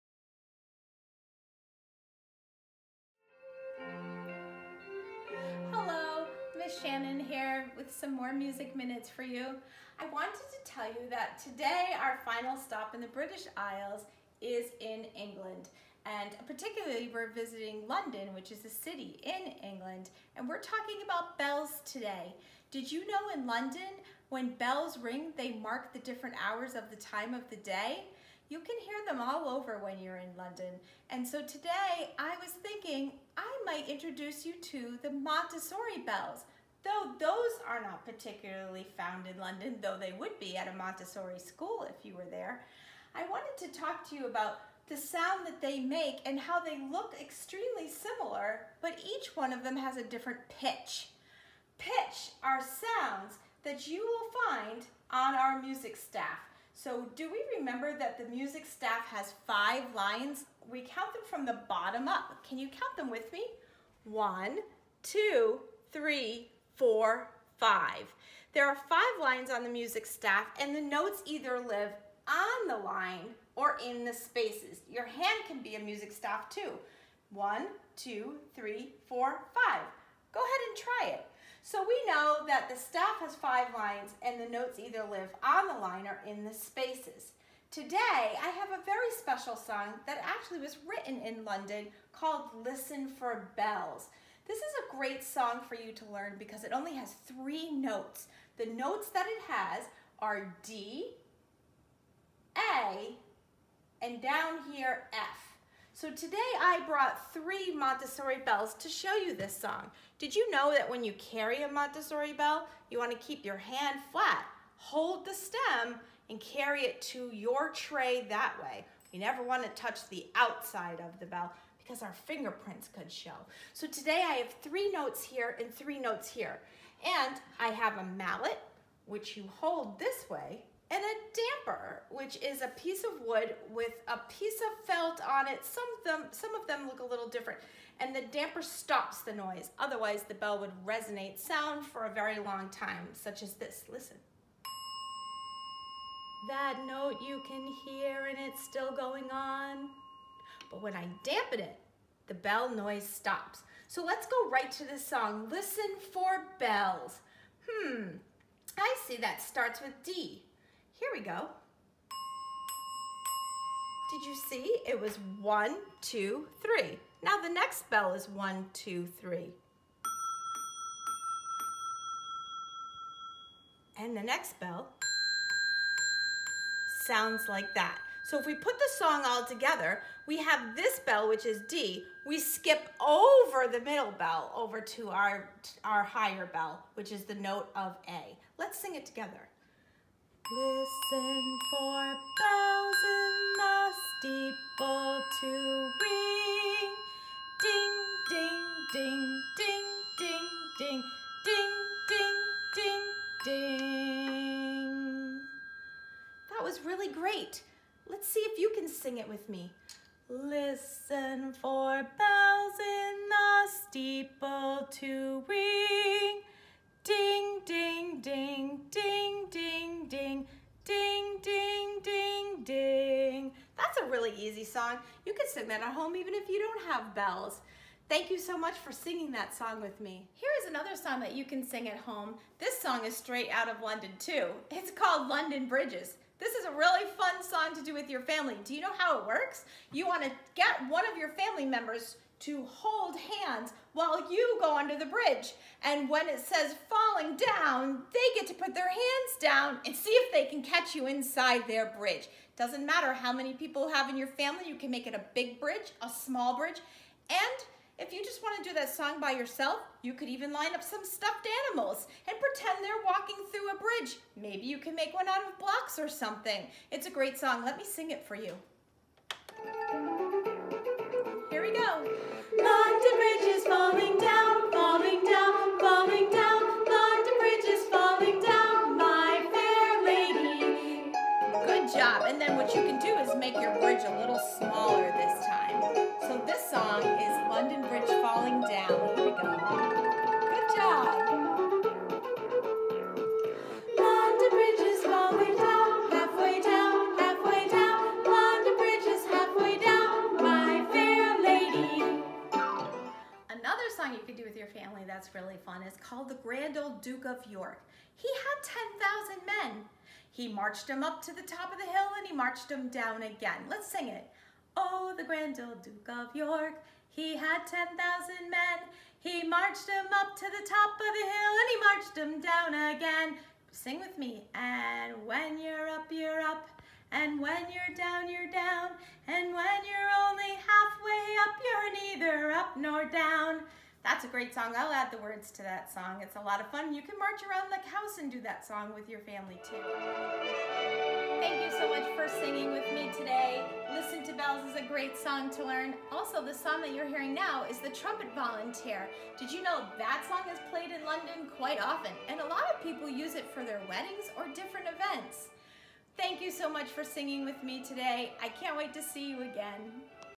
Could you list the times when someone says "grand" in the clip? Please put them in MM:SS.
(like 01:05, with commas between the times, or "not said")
05:06, 05:15.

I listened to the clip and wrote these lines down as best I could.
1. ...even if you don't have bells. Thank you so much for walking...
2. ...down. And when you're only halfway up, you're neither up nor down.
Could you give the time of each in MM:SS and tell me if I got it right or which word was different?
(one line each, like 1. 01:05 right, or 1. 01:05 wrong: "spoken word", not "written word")
1. 03:46 wrong: "singing", not "walking"
2. 05:28 right.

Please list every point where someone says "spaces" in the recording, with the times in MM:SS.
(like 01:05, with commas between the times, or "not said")
01:14, 01:26.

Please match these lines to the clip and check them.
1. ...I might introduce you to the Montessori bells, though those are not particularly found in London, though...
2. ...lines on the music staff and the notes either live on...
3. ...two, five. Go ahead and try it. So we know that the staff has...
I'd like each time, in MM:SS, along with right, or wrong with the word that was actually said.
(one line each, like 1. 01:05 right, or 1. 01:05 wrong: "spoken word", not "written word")
1. 00:33 right
2. 01:09 right
3. 01:19 wrong: "four", not "two".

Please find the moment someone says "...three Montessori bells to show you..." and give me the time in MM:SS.
01:47.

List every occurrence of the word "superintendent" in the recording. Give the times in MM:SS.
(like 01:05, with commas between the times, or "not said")
not said.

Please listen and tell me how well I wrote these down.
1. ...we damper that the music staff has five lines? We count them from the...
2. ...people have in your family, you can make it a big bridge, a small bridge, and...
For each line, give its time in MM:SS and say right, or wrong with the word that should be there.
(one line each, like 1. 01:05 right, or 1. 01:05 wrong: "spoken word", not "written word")
1. 00:57 wrong: "remember", not "damper"
2. 04:13 right.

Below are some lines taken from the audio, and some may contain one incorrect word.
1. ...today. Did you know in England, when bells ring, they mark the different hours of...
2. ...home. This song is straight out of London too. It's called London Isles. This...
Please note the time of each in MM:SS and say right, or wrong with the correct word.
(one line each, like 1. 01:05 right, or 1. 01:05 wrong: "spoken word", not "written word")
1. 00:21 wrong: "London", not "England"
2. 03:51 wrong: "Bridges", not "Isles".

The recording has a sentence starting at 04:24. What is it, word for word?
Maybe you can make one out of blocks or something.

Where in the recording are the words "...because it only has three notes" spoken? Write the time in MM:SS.
01:36.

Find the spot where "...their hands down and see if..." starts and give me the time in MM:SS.
04:08.